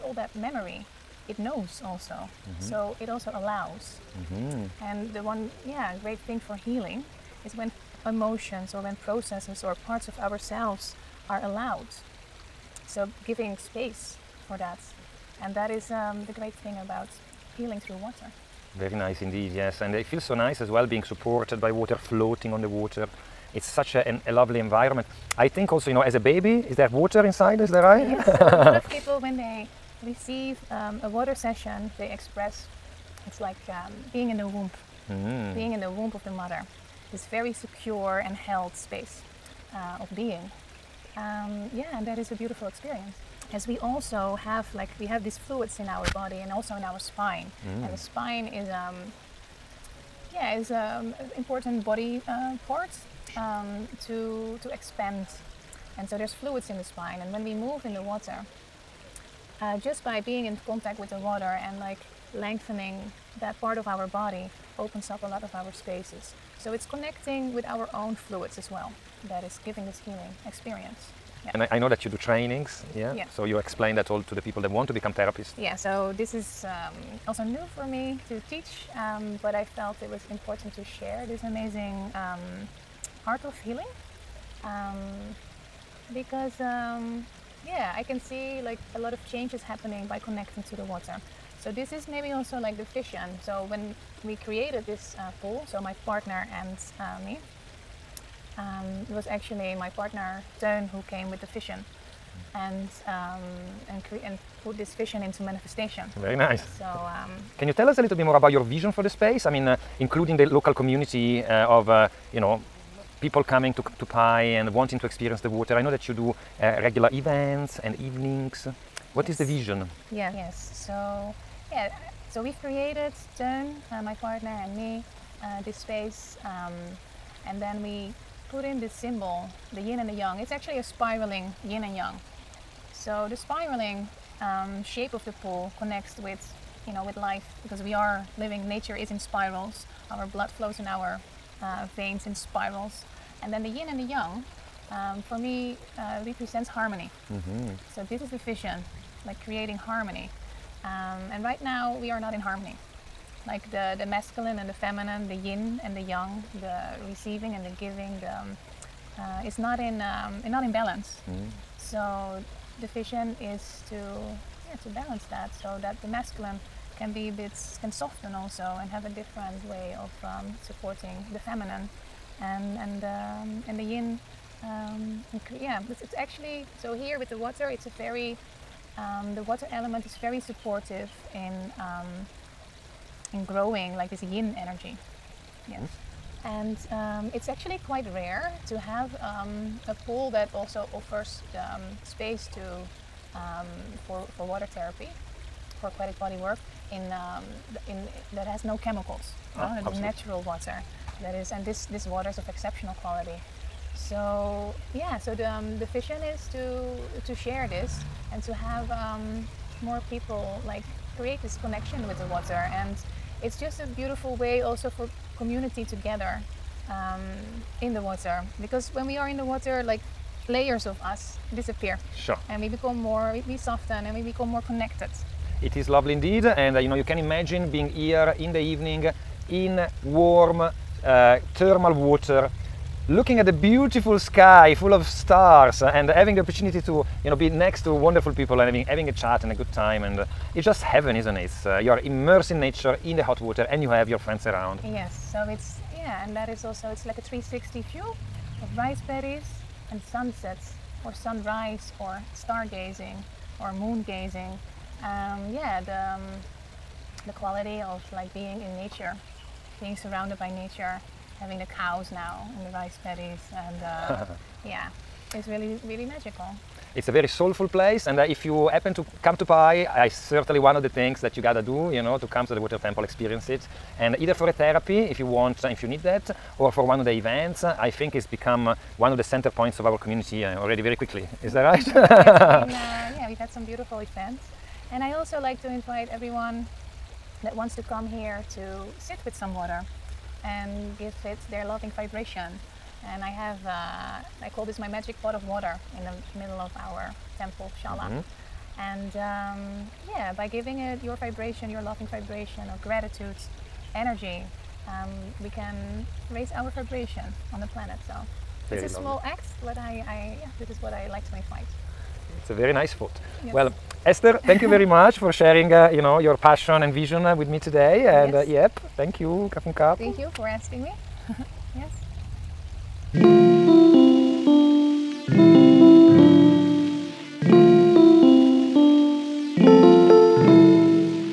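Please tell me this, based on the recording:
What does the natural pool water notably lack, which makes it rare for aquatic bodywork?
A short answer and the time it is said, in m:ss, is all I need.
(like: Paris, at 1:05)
Chemicals, at 3:18.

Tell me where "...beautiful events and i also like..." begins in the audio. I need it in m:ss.
4:43.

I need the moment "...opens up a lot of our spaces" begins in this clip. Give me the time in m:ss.
1:04.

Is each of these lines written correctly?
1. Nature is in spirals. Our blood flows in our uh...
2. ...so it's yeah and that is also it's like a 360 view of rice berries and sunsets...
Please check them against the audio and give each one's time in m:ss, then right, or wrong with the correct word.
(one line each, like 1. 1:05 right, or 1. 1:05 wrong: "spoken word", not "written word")
1. 2:18 right
2. 4:05 right.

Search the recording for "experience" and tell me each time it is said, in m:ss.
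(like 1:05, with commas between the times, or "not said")
0:42, 1:10, 1:55, 4:33.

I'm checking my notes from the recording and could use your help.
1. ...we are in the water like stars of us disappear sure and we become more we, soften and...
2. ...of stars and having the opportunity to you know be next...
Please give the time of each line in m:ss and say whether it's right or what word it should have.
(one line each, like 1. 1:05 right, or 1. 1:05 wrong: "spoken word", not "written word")
1. 3:39 wrong: "layers", not "stars"
2. 3:54 right.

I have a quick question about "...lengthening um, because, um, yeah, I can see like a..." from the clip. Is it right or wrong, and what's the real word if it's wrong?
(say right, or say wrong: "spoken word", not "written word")
wrong: "healing", not "lengthening".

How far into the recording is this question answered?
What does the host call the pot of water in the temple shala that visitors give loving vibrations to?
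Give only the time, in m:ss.
4:54.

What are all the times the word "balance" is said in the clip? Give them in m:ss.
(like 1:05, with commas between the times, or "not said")
2:40, 2:44.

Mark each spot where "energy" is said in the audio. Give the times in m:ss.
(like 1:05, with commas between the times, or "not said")
3:04, 5:03.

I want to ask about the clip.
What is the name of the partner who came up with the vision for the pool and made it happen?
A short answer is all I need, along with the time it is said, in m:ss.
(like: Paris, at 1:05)
Teun, at 1:40.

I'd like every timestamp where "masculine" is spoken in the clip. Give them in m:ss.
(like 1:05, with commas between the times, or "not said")
2:34, 2:46.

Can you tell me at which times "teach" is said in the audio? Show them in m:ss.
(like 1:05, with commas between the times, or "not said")
1:18.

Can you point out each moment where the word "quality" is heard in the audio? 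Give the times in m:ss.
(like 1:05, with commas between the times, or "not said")
3:23, 4:17.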